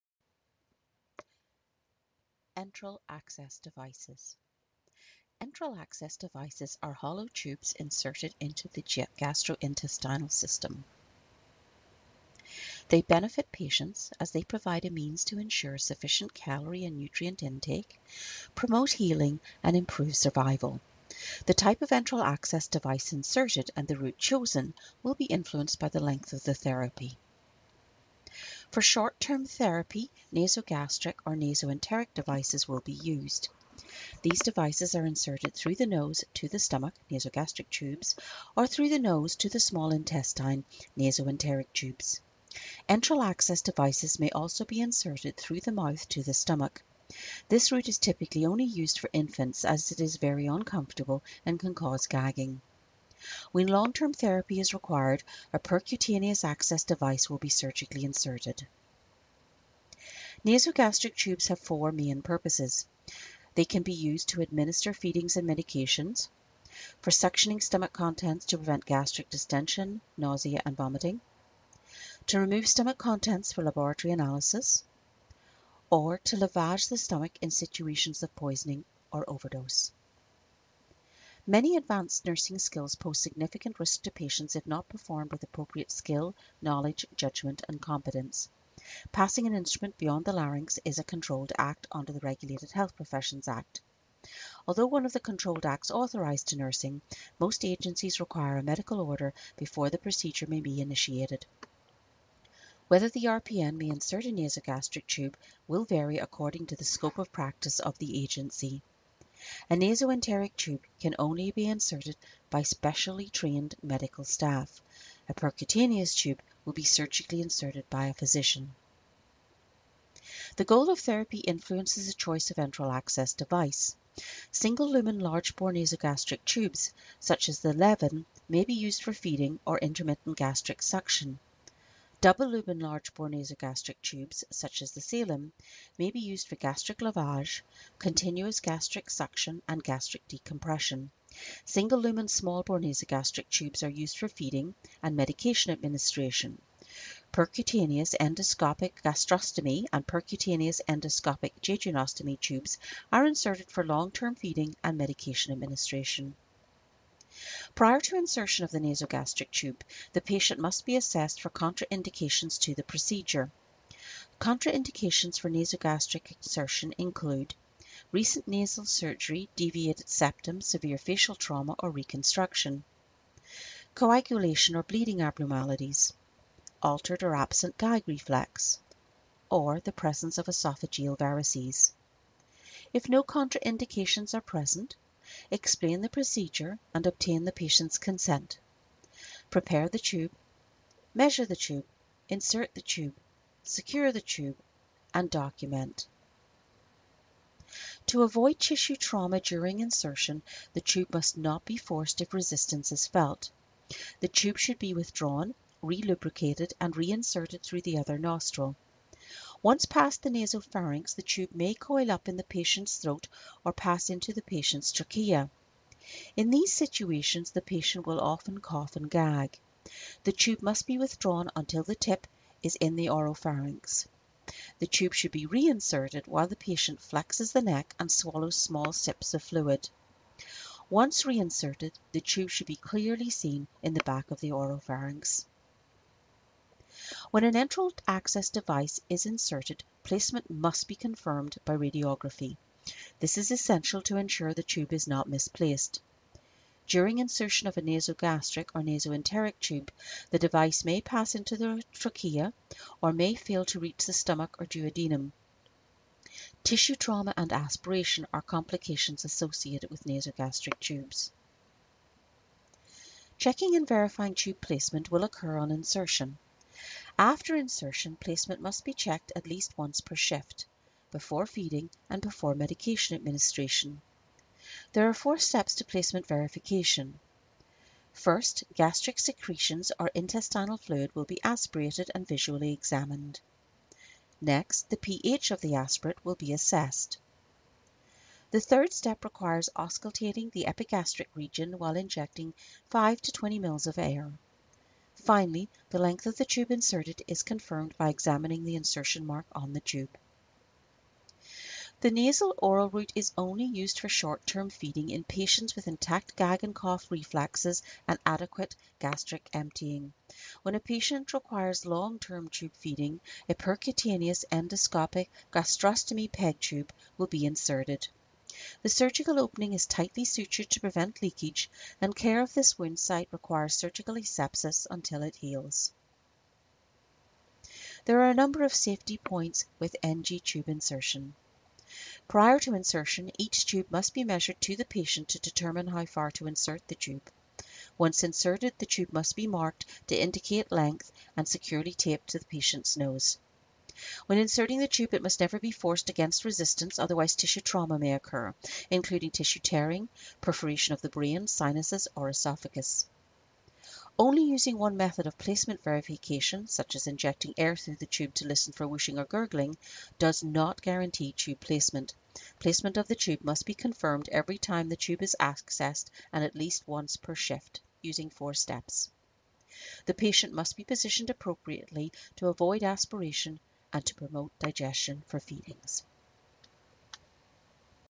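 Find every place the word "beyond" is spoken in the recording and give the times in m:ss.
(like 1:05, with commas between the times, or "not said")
1:29.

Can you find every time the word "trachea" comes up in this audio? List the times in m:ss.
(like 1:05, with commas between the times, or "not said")
3:34, 4:11.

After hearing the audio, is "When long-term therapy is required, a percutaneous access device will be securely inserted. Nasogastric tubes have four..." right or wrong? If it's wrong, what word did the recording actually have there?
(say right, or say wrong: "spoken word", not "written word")
wrong: "surgically", not "securely".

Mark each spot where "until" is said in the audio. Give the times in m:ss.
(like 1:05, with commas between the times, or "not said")
3:41, 5:24.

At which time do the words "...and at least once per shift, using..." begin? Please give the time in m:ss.
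6:06.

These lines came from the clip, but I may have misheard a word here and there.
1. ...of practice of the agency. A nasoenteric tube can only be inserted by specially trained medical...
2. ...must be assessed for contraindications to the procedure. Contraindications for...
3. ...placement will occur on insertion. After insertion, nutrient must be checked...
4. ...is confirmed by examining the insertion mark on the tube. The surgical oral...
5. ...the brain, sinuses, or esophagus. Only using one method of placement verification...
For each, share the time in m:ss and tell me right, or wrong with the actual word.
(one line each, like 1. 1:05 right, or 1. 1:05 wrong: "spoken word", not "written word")
1. 1:47 right
2. 2:40 right
3. 4:24 wrong: "placement", not "nutrient"
4. 4:57 wrong: "nasal", not "surgical"
5. 5:51 right.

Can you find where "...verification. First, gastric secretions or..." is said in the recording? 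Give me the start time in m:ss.
4:36.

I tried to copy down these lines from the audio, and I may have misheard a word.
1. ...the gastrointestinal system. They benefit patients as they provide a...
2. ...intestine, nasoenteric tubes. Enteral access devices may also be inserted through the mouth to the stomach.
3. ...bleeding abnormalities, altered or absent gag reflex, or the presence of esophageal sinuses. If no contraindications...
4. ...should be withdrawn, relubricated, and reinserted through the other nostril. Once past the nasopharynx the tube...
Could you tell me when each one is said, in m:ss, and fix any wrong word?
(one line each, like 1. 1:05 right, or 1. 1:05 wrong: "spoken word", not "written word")
1. 0:08 right
2. 0:39 right
3. 2:54 wrong: "varices", not "sinuses"
4. 3:24 right.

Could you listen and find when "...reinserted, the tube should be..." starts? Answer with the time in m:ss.
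3:51.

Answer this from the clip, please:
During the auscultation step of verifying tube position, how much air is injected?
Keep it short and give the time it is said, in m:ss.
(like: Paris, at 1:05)
5 to 20 mL, at 4:52.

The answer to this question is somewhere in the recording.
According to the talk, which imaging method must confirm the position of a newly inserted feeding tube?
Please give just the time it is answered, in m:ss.
4:01.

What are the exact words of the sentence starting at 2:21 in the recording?
Single lumen small bore nasogastric tubes are used for feeding and medication administration.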